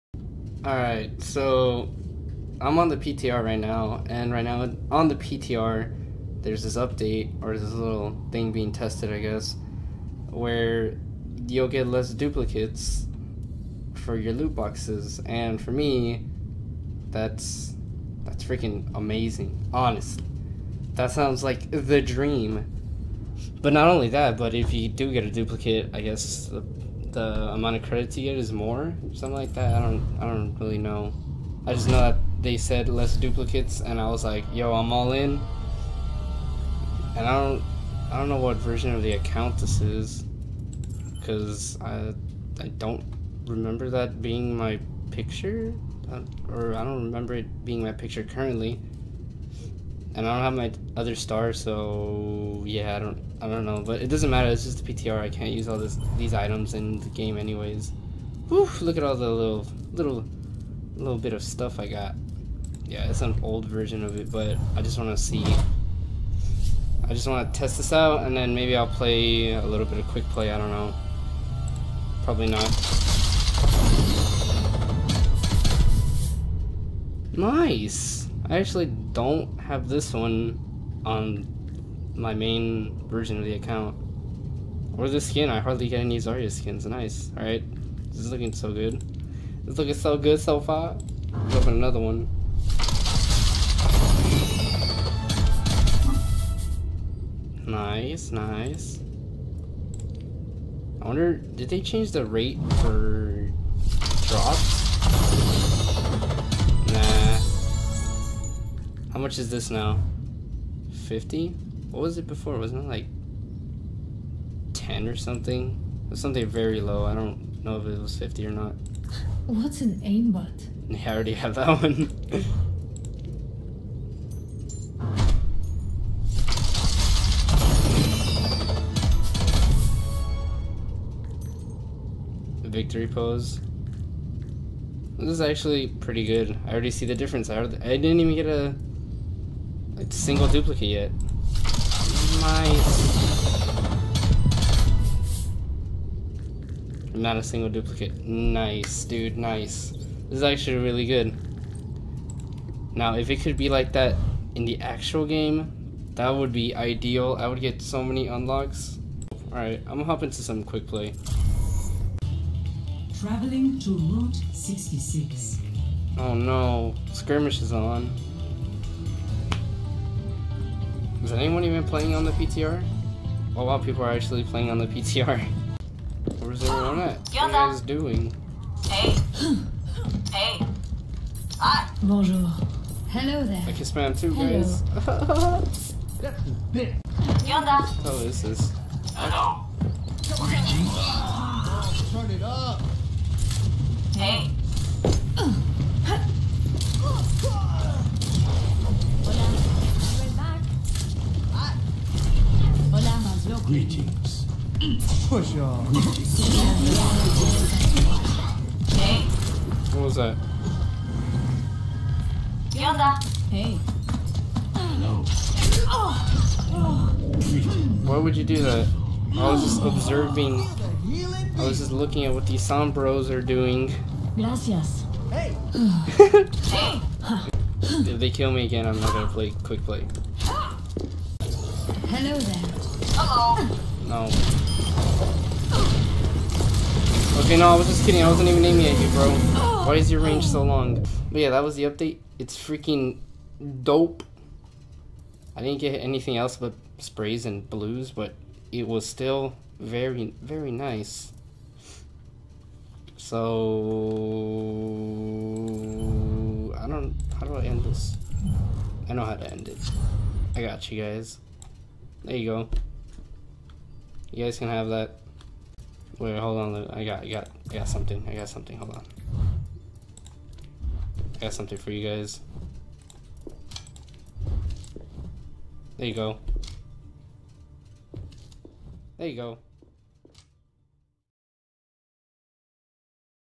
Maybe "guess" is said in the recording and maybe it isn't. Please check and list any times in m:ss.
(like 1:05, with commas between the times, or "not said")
0:09, 0:26.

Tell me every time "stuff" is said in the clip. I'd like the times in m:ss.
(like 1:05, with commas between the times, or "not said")
1:01.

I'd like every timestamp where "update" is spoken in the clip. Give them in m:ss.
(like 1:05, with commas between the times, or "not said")
0:06, 4:01.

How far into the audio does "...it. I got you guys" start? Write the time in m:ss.
4:19.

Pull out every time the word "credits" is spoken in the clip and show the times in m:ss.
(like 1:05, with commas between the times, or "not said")
0:27.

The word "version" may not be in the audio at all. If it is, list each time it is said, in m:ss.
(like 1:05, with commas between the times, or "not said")
0:38, 1:03, 1:23.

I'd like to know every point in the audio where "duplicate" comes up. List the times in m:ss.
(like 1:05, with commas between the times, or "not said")
0:12, 0:25, 0:33, 2:20, 2:27.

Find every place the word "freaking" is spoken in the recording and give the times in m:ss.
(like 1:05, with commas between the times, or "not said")
0:18, 4:02.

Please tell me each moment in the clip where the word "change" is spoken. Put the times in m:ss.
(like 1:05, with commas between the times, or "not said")
1:41.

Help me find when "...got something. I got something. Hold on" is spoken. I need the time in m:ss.
4:27.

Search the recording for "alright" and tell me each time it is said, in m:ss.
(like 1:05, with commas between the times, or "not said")
0:00, 1:27, 2:39.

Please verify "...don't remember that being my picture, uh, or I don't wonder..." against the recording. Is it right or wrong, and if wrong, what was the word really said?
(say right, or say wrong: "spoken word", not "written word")
wrong: "remember", not "wonder".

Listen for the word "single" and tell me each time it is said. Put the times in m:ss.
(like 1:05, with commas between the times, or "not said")
2:20, 2:27.